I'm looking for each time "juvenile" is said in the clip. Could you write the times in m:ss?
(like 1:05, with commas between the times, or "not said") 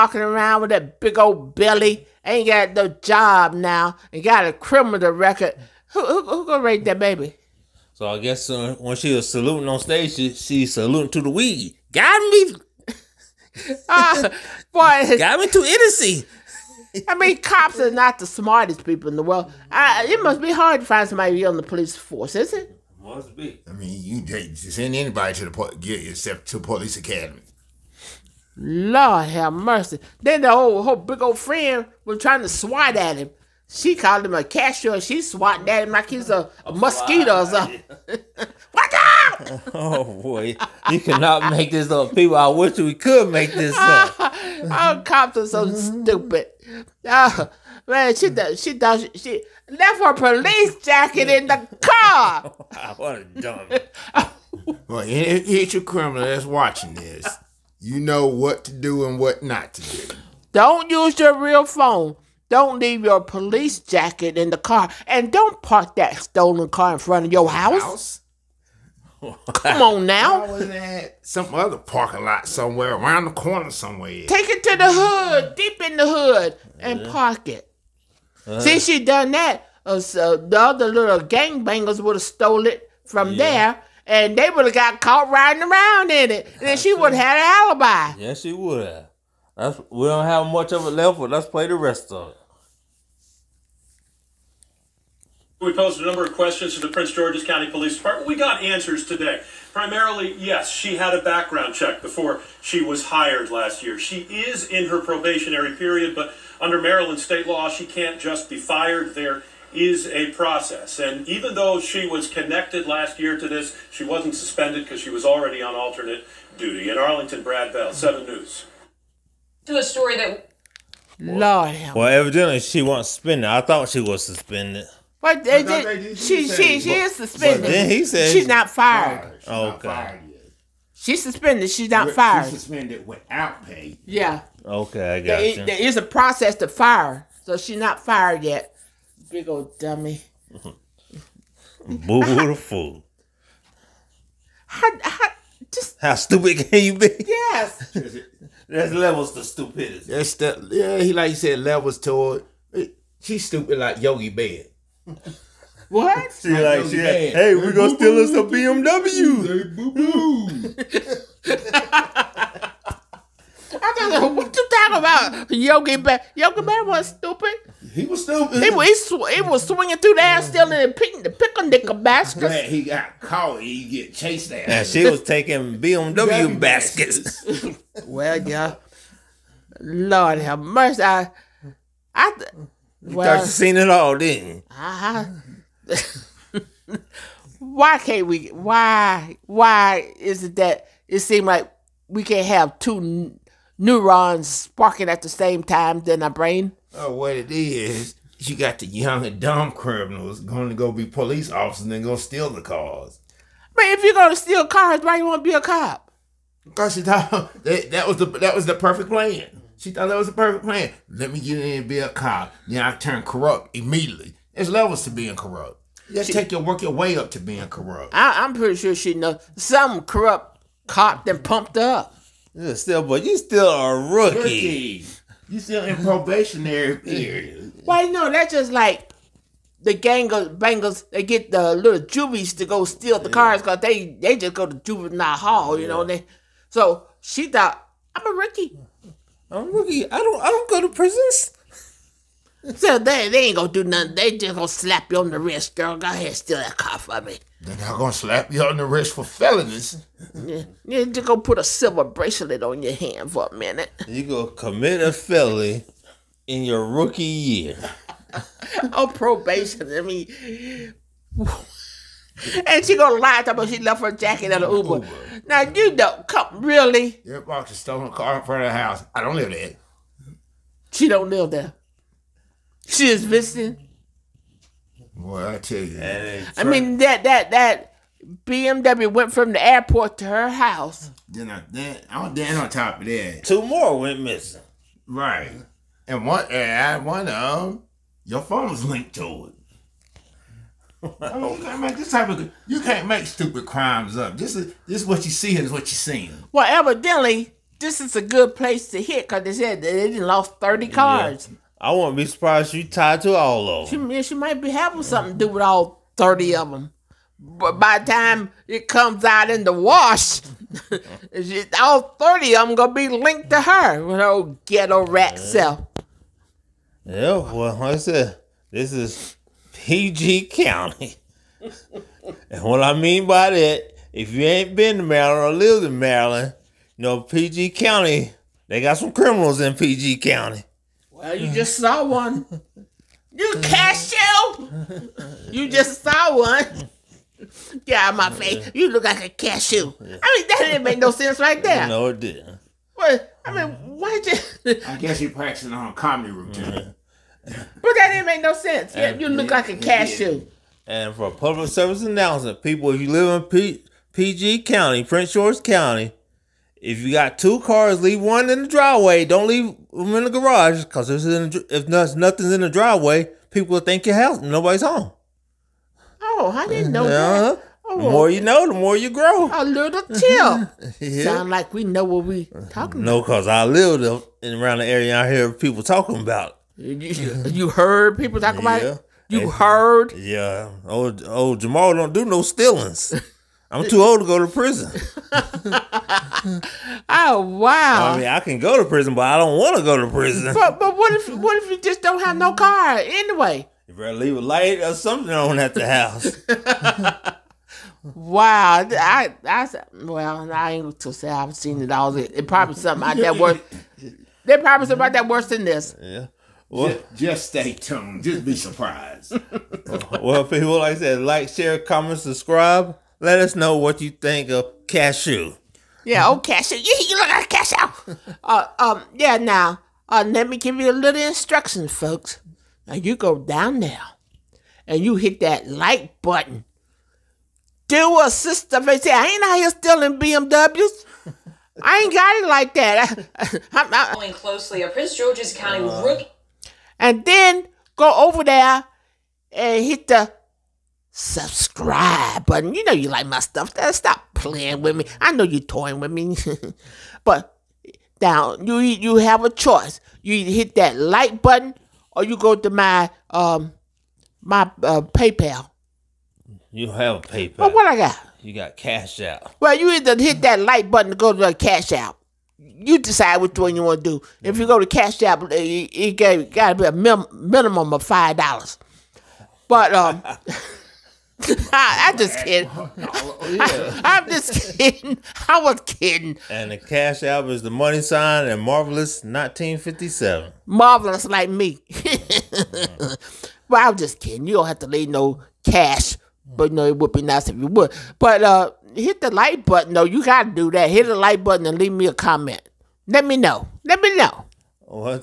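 3:54.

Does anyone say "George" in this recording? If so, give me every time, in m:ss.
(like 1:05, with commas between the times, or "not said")
1:37, 5:55, 7:15.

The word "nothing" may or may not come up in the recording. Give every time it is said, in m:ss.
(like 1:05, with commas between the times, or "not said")
4:03, 6:01.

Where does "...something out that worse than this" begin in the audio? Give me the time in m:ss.
6:44.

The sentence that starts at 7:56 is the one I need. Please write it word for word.
And the cash app is the money sign and marvelous 1957.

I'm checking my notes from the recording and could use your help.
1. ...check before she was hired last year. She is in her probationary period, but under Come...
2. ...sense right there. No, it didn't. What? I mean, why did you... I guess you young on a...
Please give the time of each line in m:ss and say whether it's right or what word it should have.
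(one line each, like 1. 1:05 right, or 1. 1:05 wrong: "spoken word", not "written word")
1. 1:41 wrong: "Maryland", not "Come"
2. 5:41 wrong: "practicing", not "young".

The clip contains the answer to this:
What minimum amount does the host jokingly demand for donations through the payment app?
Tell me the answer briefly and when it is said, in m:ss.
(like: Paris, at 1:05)
$5, at 7:48.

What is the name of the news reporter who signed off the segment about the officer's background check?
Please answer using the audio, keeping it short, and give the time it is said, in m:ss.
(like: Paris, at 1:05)
Brad Bell, at 1:57.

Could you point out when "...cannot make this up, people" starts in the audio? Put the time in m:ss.
0:40.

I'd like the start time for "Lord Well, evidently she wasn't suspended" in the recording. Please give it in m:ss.
2:01.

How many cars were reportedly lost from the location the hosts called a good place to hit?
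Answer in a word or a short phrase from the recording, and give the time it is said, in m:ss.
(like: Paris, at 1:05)
30, at 5:00.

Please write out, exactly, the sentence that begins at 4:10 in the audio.
yeah, you're just gonna put a silver bracelet on your hand for a minute.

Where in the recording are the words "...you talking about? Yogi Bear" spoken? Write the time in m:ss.
2:44.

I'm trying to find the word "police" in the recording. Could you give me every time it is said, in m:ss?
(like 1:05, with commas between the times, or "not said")
0:21, 0:26, 0:50, 1:03, 1:37, 3:21.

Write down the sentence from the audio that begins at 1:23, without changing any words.
there, and they would have got caught riding around in it.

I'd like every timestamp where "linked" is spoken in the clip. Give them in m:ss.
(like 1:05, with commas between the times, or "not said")
4:48, 5:13.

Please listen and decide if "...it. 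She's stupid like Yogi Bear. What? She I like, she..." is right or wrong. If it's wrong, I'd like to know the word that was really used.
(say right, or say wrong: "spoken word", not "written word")
right.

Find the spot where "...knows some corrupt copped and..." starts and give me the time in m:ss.
3:39.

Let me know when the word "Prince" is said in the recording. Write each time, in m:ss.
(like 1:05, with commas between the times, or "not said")
1:36, 5:55, 7:14.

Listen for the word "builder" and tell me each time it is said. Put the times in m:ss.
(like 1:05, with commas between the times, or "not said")
not said.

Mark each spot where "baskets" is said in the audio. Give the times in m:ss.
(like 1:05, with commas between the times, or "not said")
2:51, 2:56.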